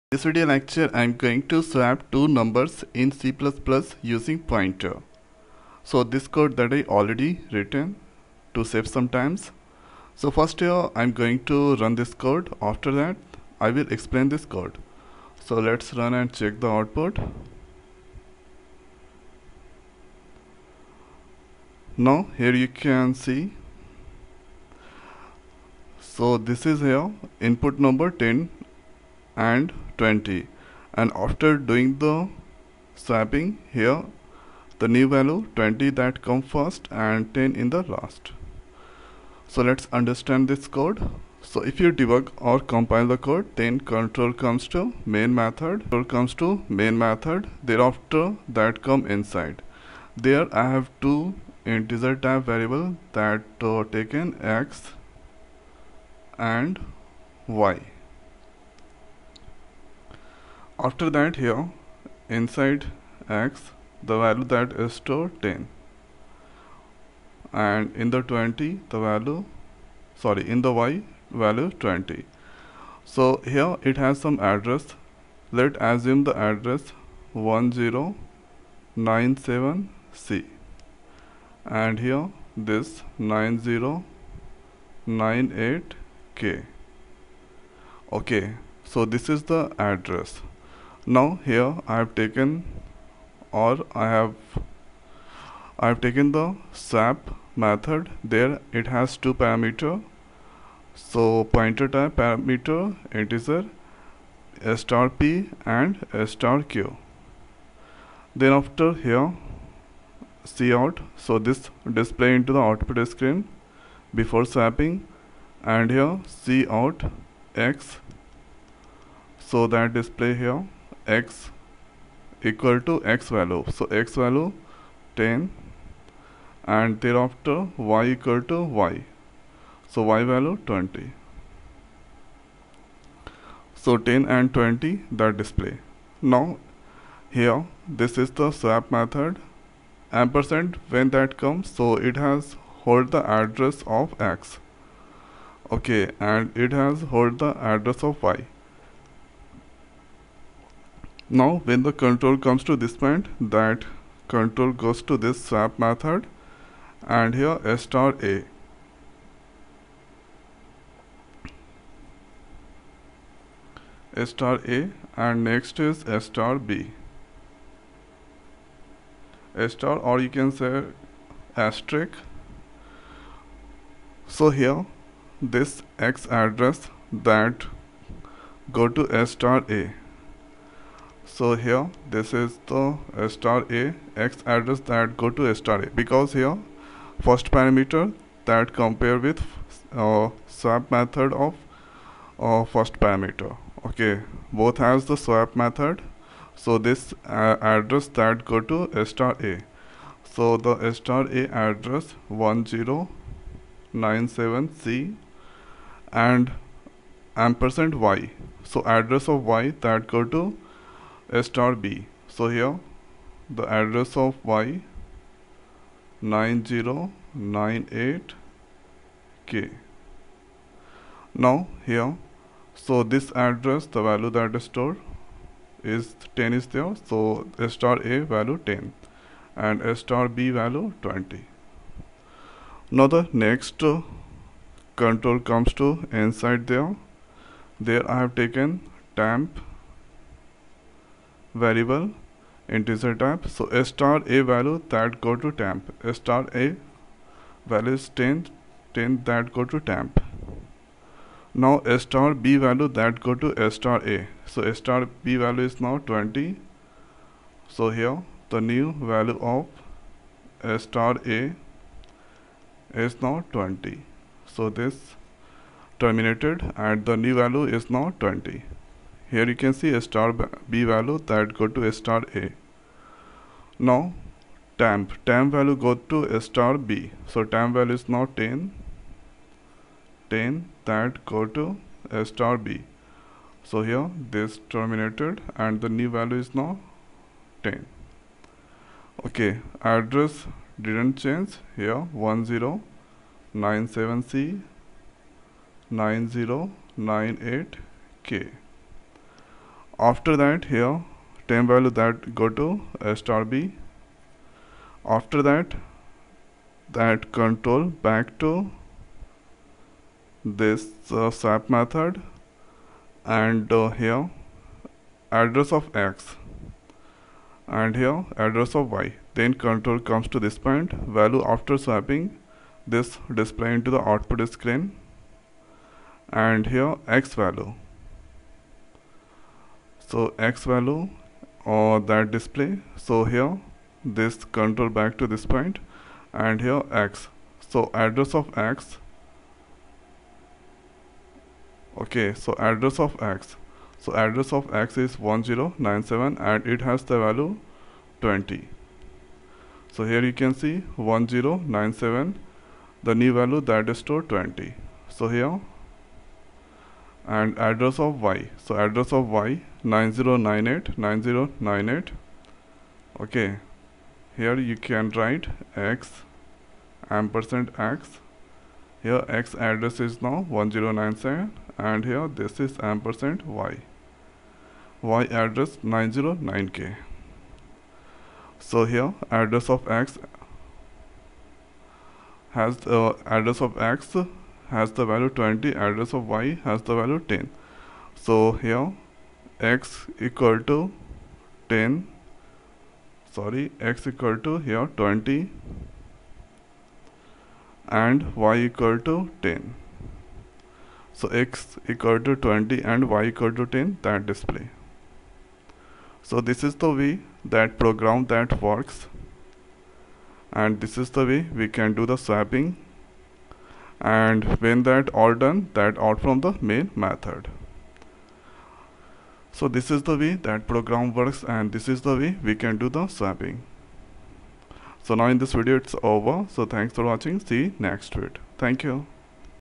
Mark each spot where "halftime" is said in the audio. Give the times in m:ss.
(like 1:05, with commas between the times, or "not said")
not said.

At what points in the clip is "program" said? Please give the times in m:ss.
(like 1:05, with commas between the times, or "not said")
6:47, 7:00.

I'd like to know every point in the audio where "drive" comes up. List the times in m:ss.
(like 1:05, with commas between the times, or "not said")
not said.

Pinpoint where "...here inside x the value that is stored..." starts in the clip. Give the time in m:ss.
1:01.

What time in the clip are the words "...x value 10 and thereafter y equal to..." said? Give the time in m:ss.
2:03.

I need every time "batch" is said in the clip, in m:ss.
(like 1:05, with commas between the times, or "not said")
not said.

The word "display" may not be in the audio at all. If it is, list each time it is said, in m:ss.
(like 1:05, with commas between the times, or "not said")
1:51, 1:59, 2:15, 5:23, 5:32, 6:44.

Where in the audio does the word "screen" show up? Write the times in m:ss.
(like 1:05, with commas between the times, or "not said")
1:53, 5:24.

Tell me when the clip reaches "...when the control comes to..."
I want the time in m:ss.
2:31.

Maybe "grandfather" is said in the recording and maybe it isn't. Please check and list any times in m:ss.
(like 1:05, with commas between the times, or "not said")
not said.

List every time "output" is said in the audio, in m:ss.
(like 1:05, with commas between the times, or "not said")
0:16, 1:52, 5:24.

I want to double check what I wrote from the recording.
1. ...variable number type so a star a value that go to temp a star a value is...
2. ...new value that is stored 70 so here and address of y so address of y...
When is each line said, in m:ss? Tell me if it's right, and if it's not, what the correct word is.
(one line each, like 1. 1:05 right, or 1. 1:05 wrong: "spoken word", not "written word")
1. 4:01 wrong: "integer", not "number"
2. 5:53 wrong: "20", not "70".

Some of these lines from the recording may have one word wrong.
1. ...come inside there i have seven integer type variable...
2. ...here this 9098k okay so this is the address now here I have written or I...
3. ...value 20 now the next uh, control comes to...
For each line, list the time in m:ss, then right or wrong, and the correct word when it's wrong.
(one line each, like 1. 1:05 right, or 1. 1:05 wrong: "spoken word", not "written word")
1. 0:48 wrong: "two", not "seven"
2. 1:22 wrong: "taken", not "written"
3. 3:50 right.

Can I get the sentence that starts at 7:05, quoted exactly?
So now in this video it's over.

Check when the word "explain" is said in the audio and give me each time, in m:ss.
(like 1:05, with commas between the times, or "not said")
0:13.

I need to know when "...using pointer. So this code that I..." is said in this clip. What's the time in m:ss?
0:04.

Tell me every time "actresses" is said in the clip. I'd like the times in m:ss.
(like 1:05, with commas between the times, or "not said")
not said.